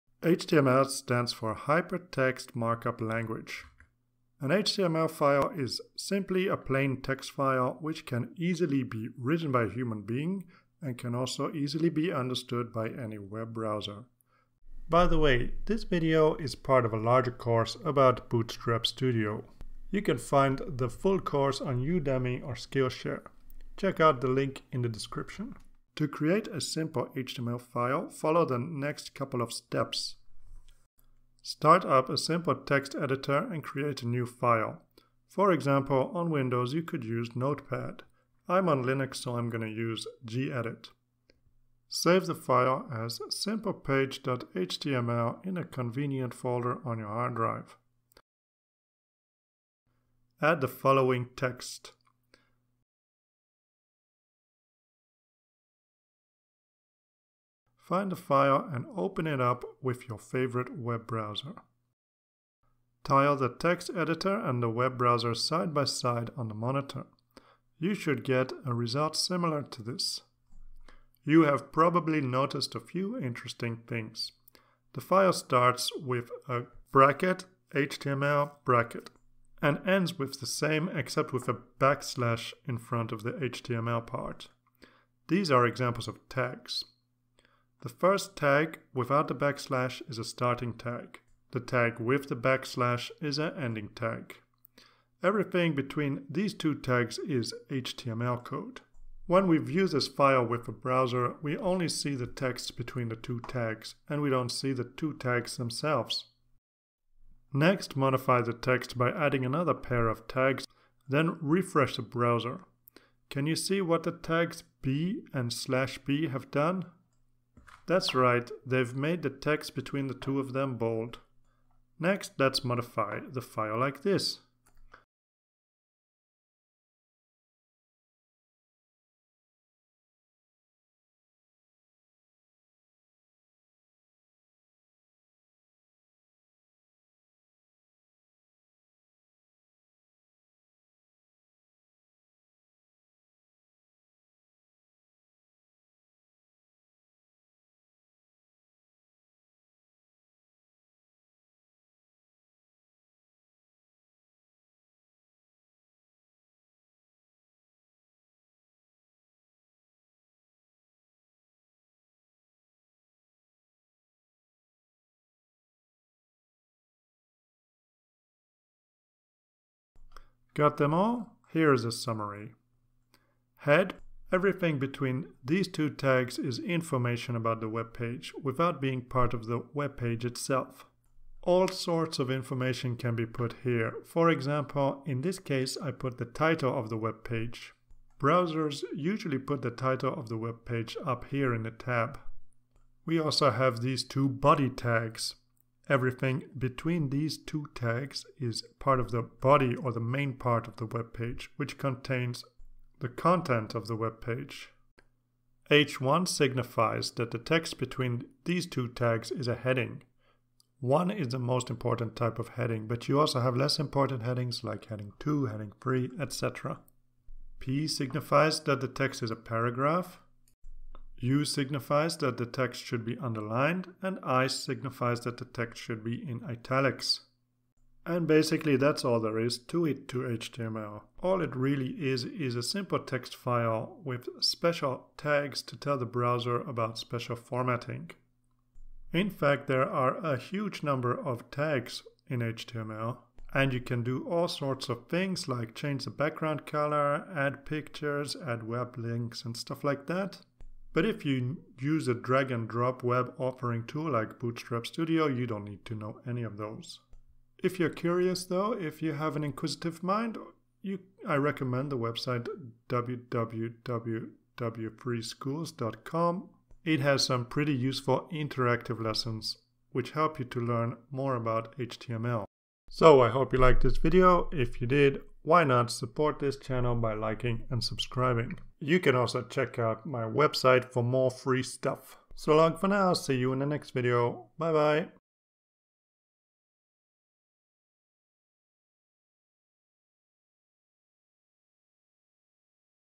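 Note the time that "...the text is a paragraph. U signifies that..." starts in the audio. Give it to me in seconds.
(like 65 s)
218 s.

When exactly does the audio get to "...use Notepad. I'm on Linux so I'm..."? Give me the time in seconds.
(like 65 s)
37 s.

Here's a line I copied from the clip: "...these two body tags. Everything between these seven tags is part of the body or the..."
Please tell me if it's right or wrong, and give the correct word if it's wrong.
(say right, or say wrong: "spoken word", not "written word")
wrong: "two", not "seven".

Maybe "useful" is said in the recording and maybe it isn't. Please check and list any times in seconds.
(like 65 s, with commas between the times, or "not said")
267 s.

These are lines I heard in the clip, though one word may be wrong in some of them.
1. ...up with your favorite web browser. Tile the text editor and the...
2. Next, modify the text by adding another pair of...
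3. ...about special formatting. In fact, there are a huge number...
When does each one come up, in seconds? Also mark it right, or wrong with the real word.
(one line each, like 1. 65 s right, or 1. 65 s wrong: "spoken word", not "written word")
1. 59 s right
2. 107 s right
3. 236 s right.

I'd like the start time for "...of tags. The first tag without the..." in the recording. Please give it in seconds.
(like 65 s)
86 s.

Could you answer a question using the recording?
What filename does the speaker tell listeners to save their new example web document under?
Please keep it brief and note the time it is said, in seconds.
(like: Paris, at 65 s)
simplepage.html, at 43 s.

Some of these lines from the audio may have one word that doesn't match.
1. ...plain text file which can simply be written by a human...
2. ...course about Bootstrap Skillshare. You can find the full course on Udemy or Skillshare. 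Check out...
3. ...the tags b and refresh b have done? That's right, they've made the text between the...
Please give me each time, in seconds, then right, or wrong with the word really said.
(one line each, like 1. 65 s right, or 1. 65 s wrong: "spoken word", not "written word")
1. 6 s wrong: "easily", not "simply"
2. 17 s wrong: "Studio", not "Skillshare"
3. 114 s wrong: "slash", not "refresh".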